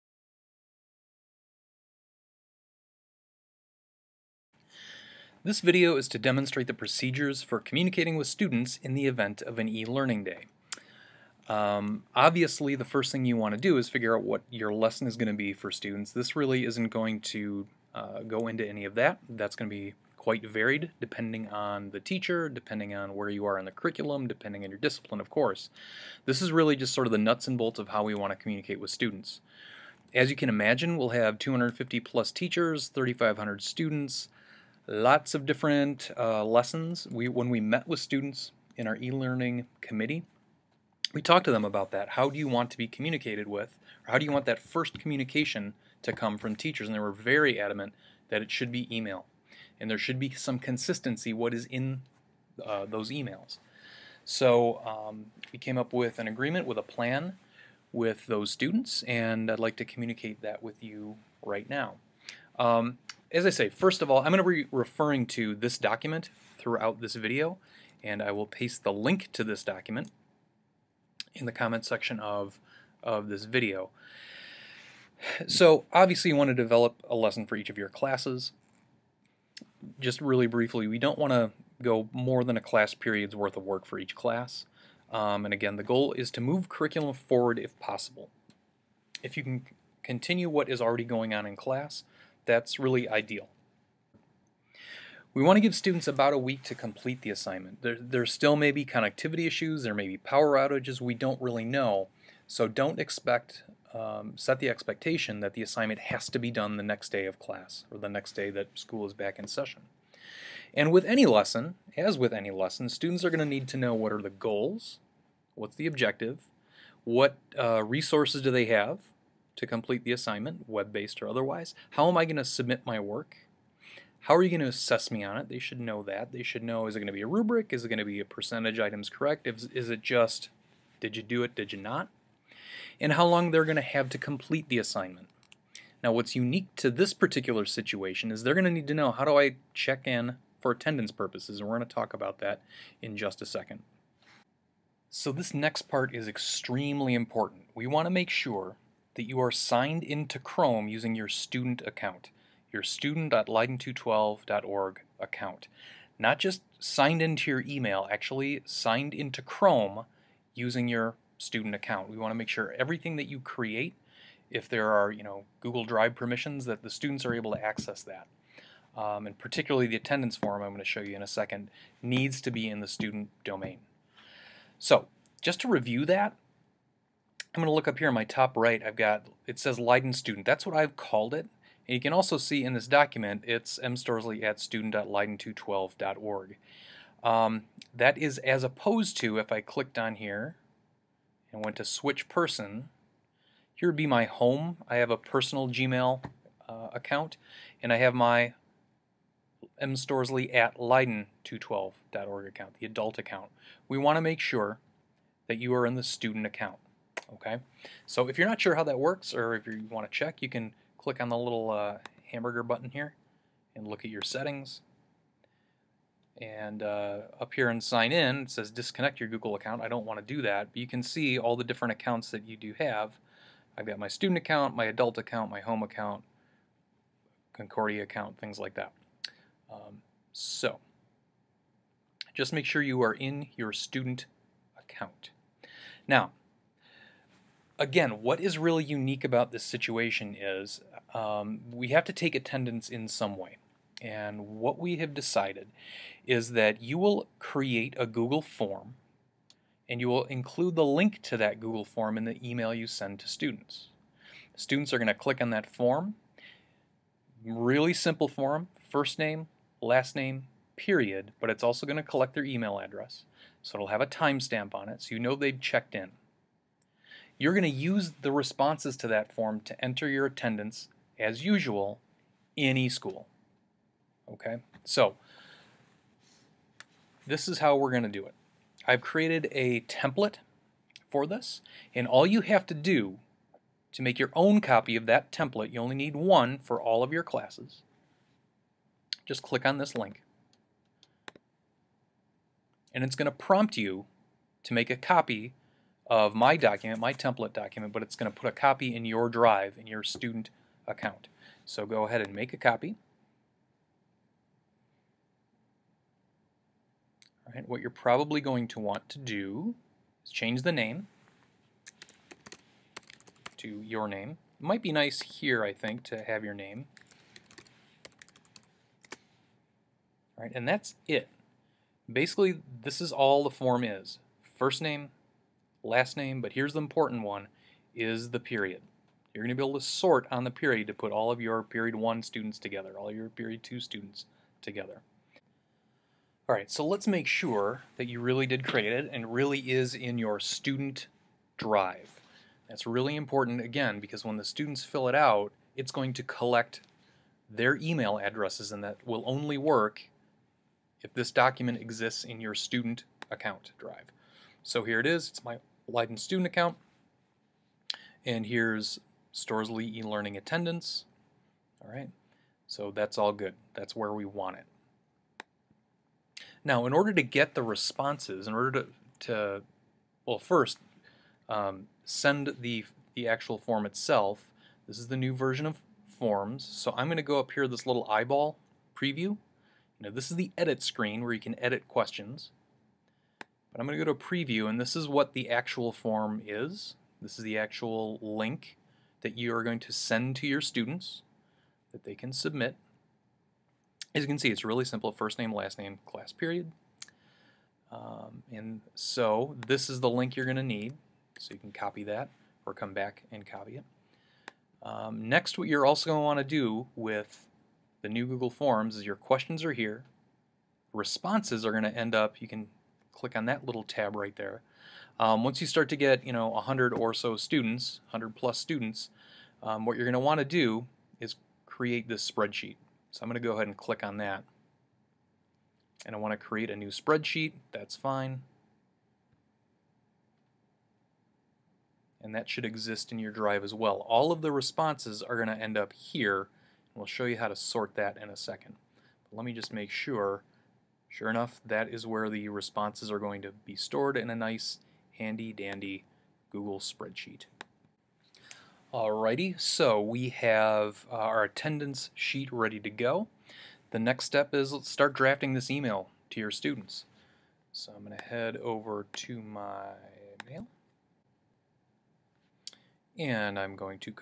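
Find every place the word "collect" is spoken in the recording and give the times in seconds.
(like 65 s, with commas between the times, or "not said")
262 s, 346 s.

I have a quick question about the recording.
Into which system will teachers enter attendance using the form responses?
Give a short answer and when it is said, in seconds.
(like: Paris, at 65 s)
eSchool, at 272 s.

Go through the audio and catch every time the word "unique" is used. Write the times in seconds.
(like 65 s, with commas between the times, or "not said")
136 s, 238 s.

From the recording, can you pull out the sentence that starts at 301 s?
So go ahead and make a copy.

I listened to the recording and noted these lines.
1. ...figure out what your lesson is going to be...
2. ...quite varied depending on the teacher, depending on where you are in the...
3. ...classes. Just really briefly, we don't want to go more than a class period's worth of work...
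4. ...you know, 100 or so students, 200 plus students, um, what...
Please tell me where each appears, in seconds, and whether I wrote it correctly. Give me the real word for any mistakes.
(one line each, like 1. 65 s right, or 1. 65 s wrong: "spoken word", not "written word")
1. 13 s right
2. 20 s right
3. 77 s right
4. 416 s wrong: "100", not "200".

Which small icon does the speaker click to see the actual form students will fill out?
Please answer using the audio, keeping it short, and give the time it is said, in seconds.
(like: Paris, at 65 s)
Eyeball preview, at 378 s.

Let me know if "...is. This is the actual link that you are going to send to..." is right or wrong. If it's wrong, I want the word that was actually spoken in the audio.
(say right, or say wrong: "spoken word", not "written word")
right.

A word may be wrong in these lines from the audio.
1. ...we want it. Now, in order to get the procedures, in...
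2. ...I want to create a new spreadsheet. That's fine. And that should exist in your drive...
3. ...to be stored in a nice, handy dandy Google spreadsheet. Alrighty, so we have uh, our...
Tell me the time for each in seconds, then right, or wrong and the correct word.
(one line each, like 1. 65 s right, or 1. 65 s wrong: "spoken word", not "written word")
1. 364 s wrong: "responses", not "procedures"
2. 426 s right
3. 443 s right.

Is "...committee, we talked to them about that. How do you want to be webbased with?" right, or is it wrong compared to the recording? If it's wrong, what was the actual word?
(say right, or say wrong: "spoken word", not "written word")
wrong: "communicated", not "webbased".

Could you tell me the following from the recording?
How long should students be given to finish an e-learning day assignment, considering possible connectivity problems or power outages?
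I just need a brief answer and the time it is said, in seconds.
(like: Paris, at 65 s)
About a week, at 96 s.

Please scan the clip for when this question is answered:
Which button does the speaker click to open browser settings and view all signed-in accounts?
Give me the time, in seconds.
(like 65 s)
212 s.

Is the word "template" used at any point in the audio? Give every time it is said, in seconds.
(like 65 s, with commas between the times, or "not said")
279 s, 285 s, 297 s.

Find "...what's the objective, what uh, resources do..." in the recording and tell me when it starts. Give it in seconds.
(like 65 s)
115 s.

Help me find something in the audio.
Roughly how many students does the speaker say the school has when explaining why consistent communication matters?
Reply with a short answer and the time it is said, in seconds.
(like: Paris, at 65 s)
3,500, at 32 s.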